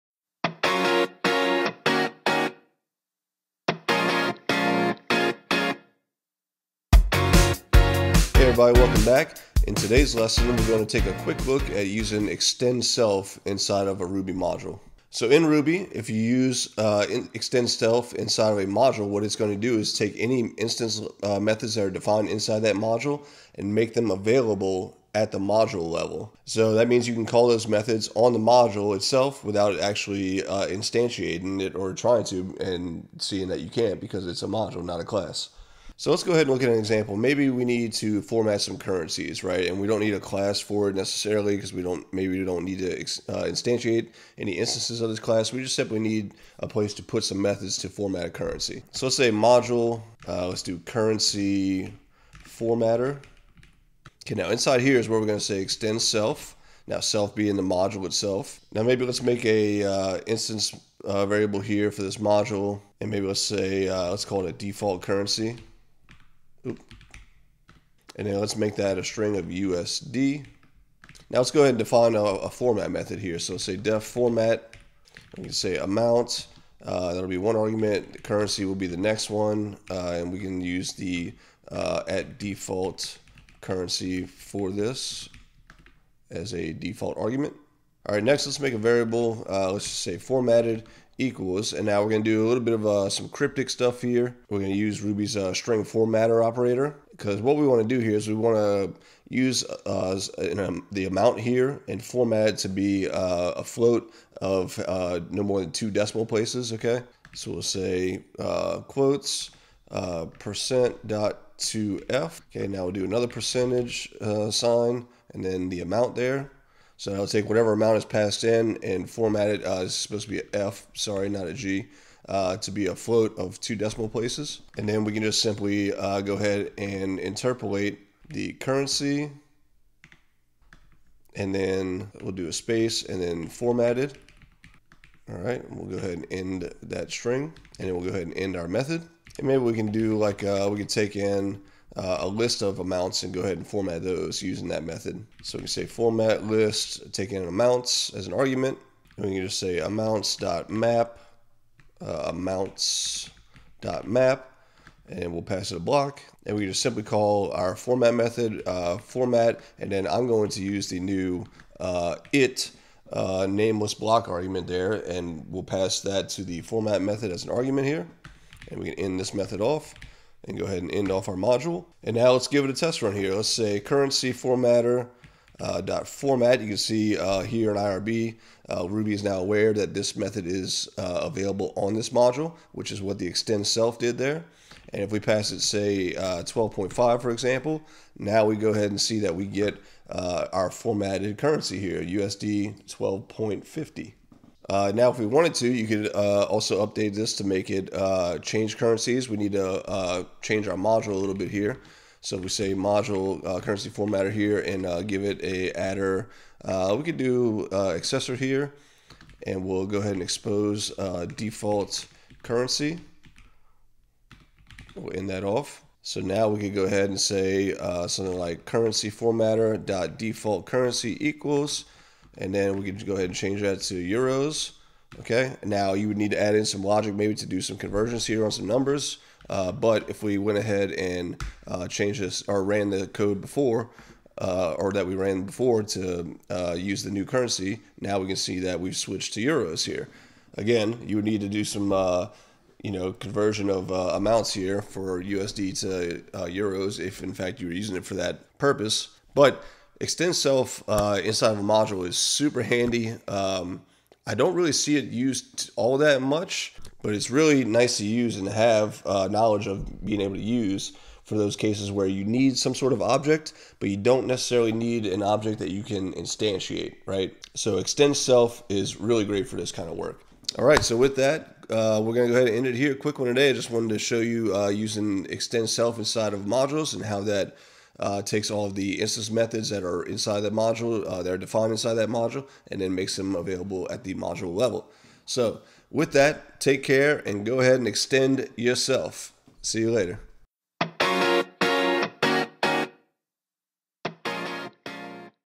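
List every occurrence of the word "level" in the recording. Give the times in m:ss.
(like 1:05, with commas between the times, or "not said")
0:25, 4:44.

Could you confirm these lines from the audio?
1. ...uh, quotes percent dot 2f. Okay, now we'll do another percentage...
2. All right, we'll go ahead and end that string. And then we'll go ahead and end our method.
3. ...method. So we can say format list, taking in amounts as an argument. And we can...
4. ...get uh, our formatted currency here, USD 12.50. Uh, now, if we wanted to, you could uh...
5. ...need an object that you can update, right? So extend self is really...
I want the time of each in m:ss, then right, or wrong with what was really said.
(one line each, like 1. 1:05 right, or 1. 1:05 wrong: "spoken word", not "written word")
1. 1:48 right
2. 2:15 right
3. 2:24 right
4. 3:09 right
5. 4:24 wrong: "instantiate", not "update".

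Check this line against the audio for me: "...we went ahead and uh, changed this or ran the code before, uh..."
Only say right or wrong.
right.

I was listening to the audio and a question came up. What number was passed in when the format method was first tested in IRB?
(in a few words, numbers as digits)
12.5.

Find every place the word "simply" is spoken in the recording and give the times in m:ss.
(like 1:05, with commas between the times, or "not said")
0:45, 2:05, 2:36.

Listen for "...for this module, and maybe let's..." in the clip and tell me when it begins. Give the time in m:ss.
1:01.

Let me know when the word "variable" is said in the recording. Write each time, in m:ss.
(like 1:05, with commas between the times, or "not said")
1:01, 1:28.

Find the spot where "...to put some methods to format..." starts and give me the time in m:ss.
0:46.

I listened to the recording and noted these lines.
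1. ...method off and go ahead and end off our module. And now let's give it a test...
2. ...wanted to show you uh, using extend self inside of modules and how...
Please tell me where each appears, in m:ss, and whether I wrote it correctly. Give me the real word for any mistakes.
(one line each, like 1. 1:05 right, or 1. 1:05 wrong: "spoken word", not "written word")
1. 2:49 right
2. 4:33 right.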